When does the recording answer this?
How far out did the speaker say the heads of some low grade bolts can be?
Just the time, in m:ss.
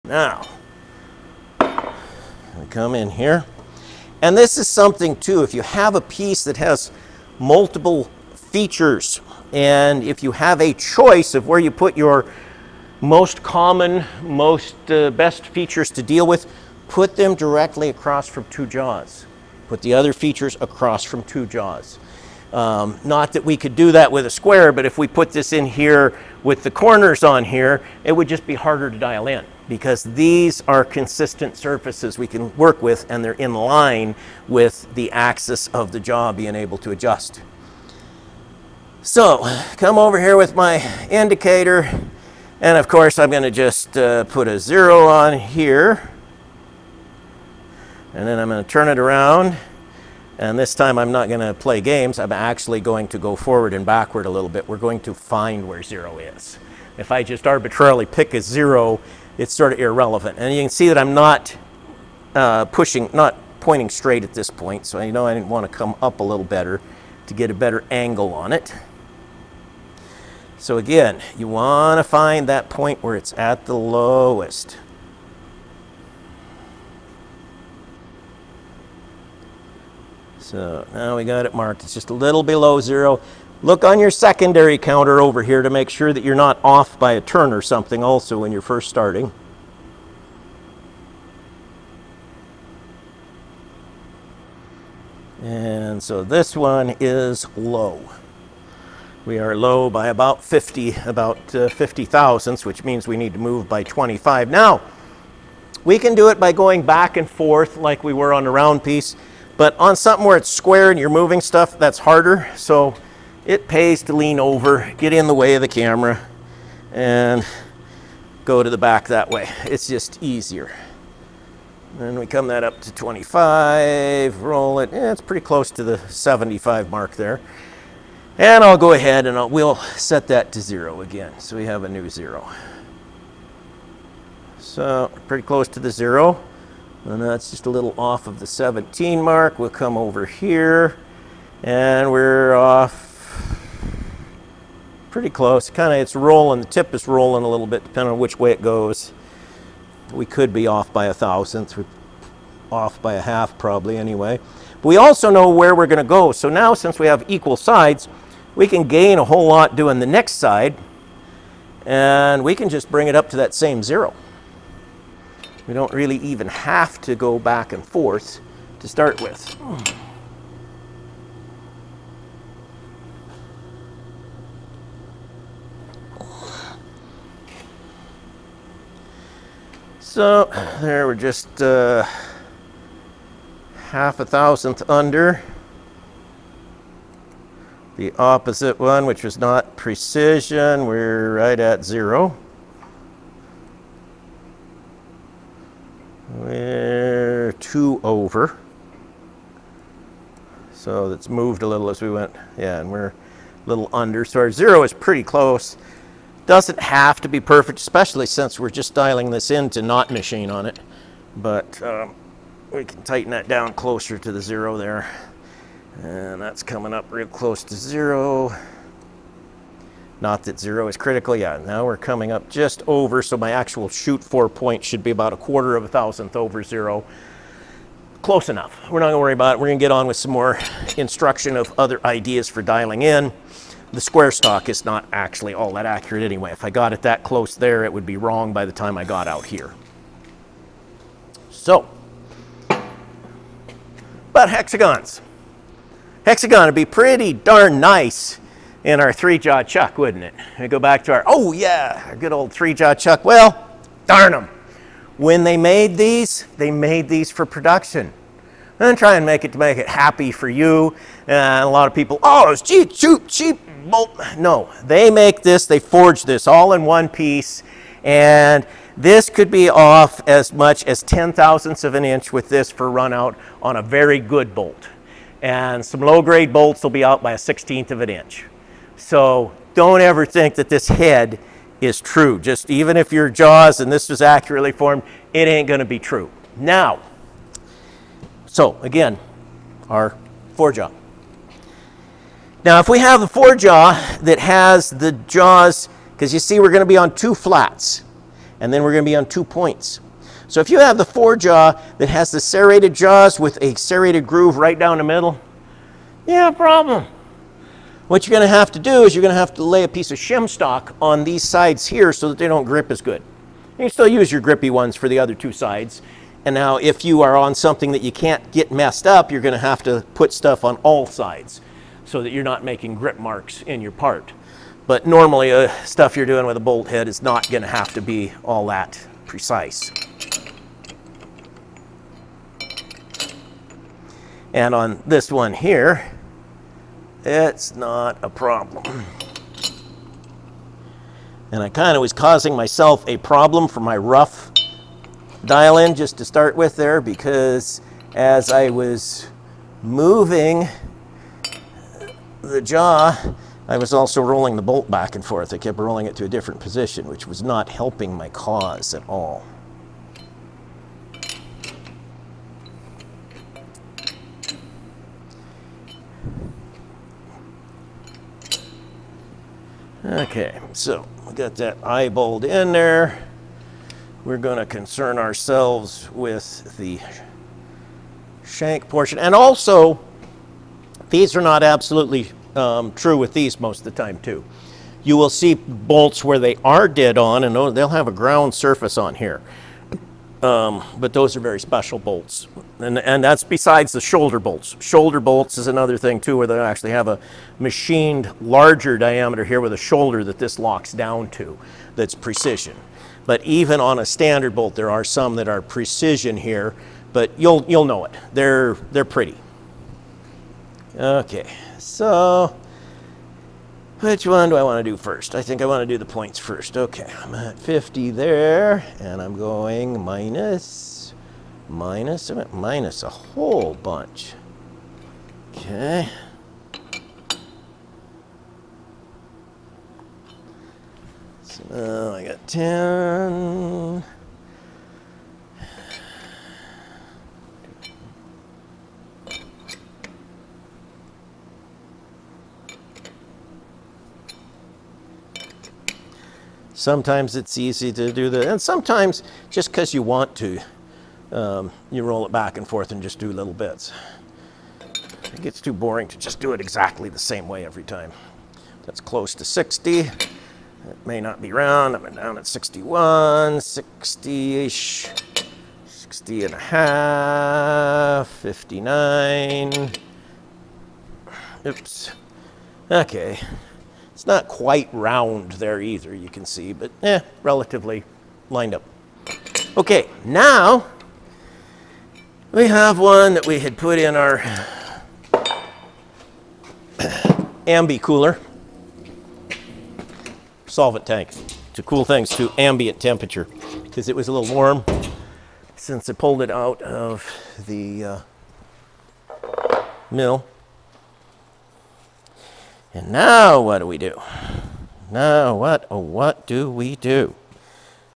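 4:37.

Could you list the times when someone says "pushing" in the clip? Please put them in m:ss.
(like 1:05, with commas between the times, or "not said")
1:02.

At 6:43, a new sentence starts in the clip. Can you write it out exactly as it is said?
But even on a standard bolt, there are some that are precision here, but you'll, you'll know it.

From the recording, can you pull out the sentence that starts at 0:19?
Put the other features across from two jaws.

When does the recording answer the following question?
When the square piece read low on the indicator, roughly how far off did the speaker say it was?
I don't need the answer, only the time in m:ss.
1:41.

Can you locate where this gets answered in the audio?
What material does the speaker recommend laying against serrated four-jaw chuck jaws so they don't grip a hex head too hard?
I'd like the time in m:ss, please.
5:10.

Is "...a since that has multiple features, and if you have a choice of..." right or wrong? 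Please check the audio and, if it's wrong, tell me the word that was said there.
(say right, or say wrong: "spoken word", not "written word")
wrong: "piece", not "since".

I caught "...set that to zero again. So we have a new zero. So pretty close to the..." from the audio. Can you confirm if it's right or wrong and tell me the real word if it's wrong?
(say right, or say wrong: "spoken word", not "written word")
right.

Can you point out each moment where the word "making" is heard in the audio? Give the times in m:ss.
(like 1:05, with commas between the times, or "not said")
5:22.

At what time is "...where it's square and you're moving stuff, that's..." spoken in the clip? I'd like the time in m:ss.
1:50.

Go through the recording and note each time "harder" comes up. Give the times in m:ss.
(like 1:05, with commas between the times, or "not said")
0:28, 1:51.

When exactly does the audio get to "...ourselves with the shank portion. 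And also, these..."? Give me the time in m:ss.
6:15.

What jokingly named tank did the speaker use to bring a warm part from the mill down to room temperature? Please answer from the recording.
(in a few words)
ambi cooler solvent tank.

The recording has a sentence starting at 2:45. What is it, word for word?
We don't really even have to go back and forth to start with.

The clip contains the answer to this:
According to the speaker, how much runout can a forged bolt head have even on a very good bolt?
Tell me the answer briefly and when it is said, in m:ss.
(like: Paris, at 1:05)
10 thousandths of an inch, at 4:31.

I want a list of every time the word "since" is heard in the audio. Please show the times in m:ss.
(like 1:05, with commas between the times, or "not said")
2:36, 3:28, 8:15.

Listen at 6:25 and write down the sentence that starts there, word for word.
You will see bolts where they are dead on and they'll have a ground surface on here.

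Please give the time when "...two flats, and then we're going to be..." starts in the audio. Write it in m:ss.
4:57.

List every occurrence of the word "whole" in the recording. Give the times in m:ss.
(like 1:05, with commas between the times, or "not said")
2:39, 7:03.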